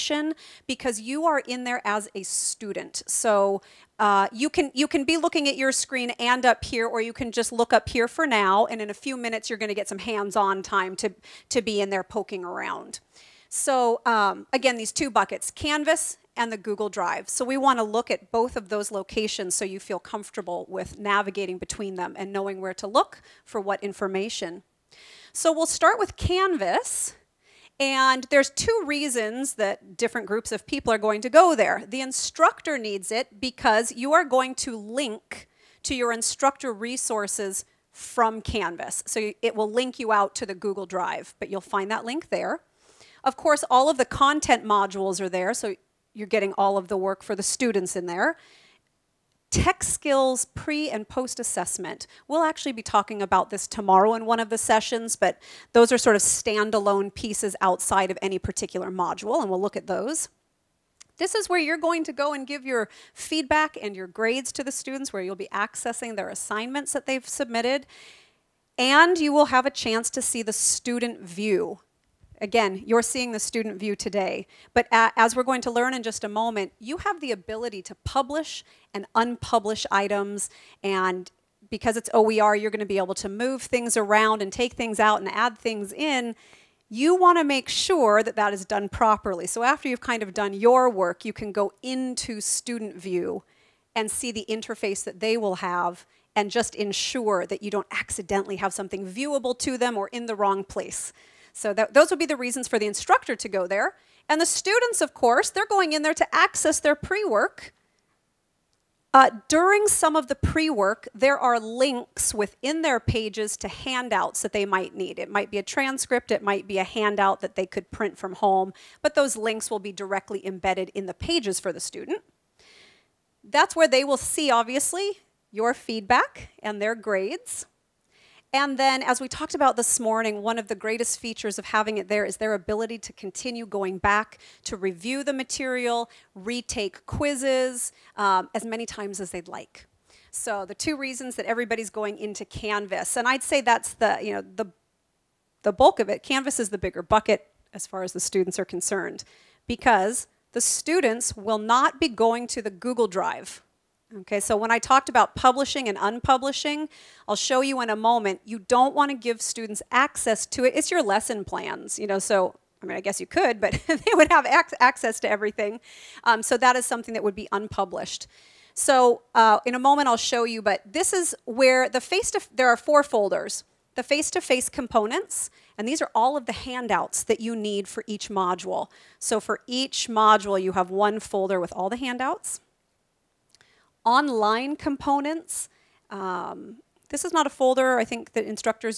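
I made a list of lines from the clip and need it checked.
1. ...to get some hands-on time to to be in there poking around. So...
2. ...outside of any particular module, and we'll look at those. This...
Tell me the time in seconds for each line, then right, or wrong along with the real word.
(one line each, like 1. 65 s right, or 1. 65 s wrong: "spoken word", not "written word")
1. 9 s right
2. 57 s right.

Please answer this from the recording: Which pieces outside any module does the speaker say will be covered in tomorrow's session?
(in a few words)
Tech skills pre and post assessment.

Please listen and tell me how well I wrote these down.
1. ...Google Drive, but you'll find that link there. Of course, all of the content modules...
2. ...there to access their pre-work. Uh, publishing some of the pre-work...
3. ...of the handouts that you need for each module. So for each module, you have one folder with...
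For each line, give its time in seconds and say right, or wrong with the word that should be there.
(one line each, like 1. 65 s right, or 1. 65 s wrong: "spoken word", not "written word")
1. 40 s right
2. 106 s wrong: "during", not "publishing"
3. 176 s right.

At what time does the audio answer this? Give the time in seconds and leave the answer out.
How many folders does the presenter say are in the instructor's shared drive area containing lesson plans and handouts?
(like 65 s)
172 s.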